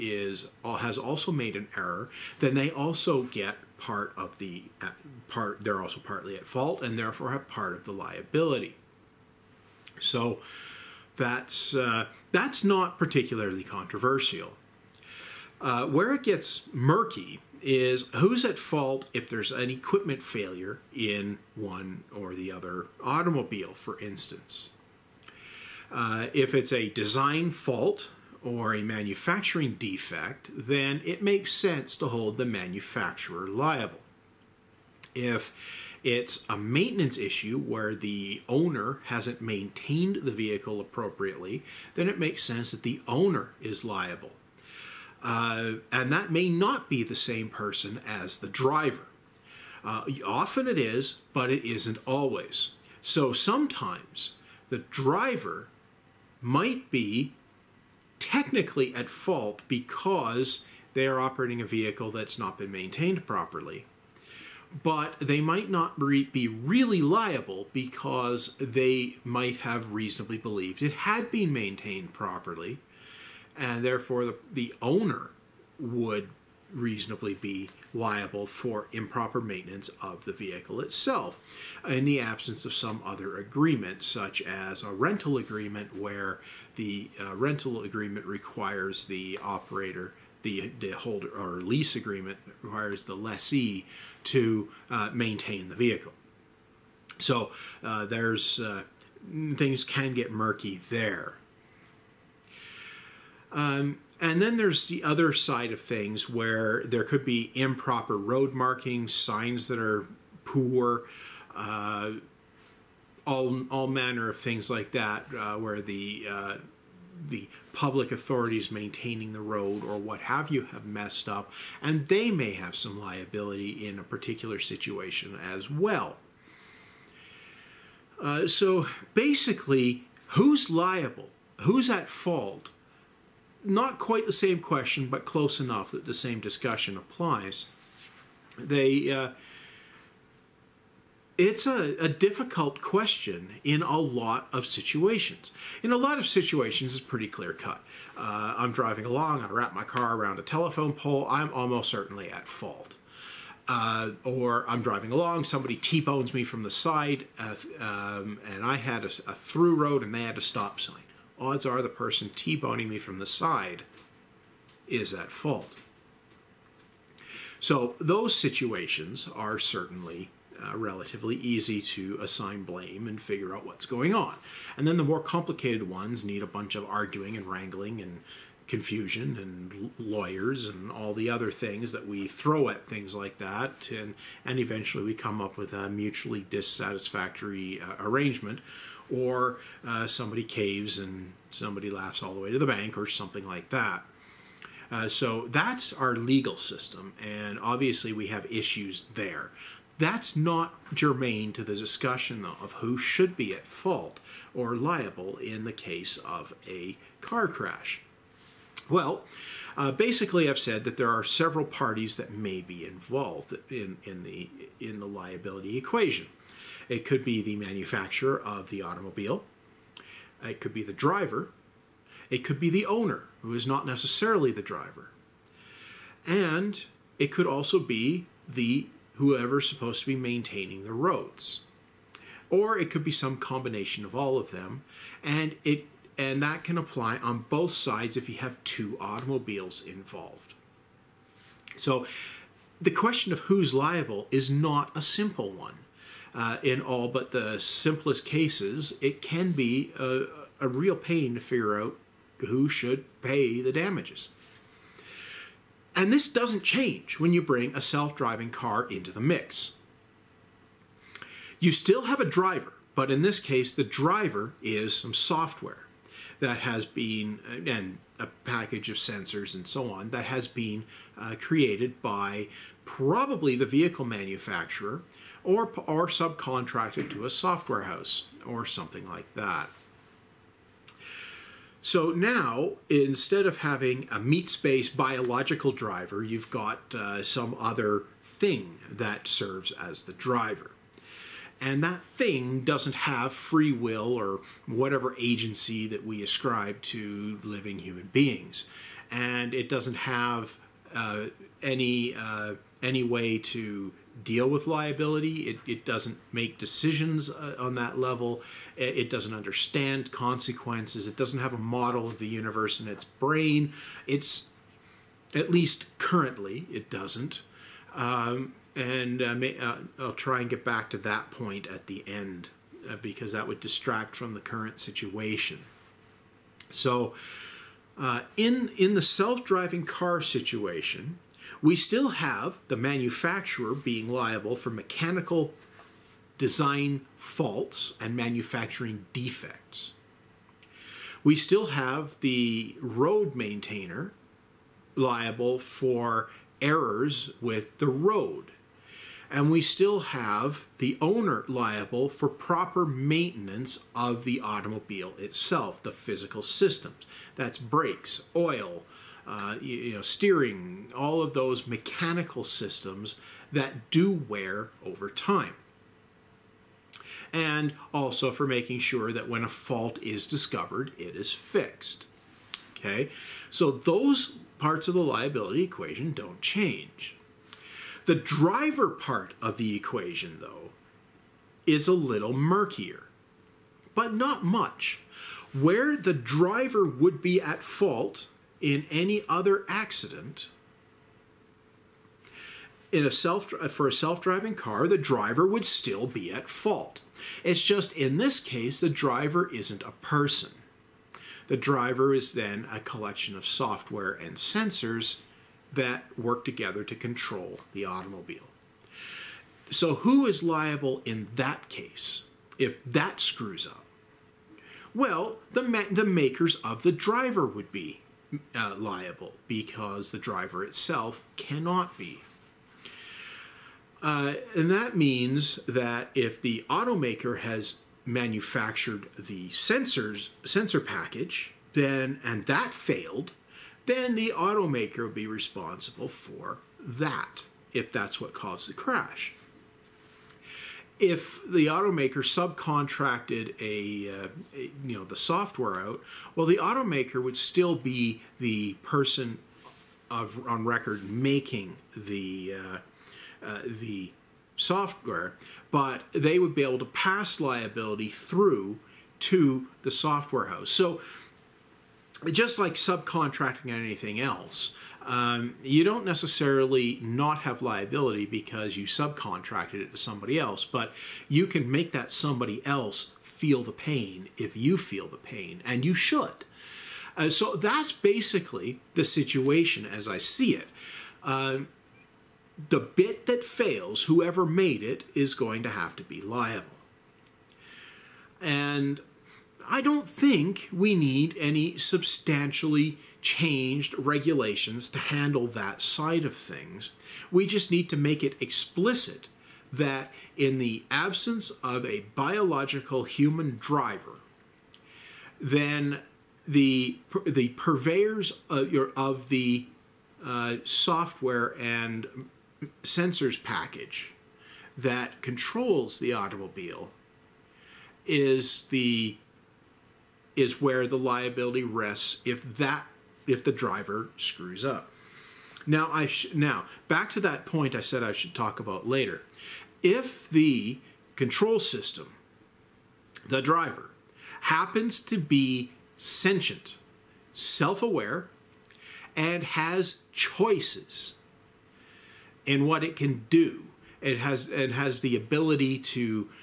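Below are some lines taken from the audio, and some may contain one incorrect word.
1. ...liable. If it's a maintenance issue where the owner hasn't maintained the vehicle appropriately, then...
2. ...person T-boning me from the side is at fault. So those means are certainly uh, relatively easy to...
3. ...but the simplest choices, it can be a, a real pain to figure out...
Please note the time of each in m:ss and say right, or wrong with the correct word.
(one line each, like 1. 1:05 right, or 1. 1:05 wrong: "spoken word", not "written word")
1. 0:33 right
2. 2:41 wrong: "situations", not "means"
3. 4:07 wrong: "cases", not "choices".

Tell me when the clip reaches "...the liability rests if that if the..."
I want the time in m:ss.
8:40.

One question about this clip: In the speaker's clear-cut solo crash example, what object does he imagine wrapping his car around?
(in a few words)
Telephone pole.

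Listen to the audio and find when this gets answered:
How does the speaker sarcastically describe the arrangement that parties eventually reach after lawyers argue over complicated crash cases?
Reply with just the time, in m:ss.
3:05.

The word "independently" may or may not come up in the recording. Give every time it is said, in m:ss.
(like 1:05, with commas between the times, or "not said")
not said.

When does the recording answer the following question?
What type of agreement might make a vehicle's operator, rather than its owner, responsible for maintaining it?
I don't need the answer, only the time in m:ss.
1:31.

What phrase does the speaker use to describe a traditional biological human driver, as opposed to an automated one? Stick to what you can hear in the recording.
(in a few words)
Meat space.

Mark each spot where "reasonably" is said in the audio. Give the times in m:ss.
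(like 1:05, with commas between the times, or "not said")
1:09, 1:16.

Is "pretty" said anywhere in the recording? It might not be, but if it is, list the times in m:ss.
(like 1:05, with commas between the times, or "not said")
2:27.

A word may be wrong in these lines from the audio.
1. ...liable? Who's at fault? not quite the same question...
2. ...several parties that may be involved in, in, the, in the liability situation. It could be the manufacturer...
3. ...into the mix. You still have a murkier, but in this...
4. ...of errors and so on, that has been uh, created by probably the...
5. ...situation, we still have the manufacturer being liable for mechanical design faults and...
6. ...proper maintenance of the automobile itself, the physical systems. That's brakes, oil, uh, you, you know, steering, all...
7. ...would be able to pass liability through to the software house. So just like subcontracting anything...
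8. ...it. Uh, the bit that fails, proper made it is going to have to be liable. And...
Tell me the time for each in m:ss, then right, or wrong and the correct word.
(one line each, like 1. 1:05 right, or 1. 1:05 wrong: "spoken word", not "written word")
1. 2:10 right
2. 3:31 wrong: "equation", not "situation"
3. 4:18 wrong: "driver", not "murkier"
4. 4:28 wrong: "sensors", not "errors"
5. 5:30 right
6. 5:52 right
7. 7:36 right
8. 8:00 wrong: "whoever", not "proper".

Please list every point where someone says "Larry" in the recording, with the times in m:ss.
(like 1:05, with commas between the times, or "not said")
not said.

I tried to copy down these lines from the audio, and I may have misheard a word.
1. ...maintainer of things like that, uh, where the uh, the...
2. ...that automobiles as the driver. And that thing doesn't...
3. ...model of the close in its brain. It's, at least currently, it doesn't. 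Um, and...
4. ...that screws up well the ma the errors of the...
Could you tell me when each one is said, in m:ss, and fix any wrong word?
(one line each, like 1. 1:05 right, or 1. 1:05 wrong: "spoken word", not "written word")
1. 1:53 wrong: "manner", not "maintainer"
2. 4:48 wrong: "serves", not "automobiles"
3. 5:11 wrong: "universe", not "close"
4. 6:52 wrong: "makers", not "errors".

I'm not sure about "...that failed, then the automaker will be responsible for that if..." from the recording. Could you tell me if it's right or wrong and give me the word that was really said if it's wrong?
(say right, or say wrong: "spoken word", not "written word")
right.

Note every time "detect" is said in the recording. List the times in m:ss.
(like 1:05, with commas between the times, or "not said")
not said.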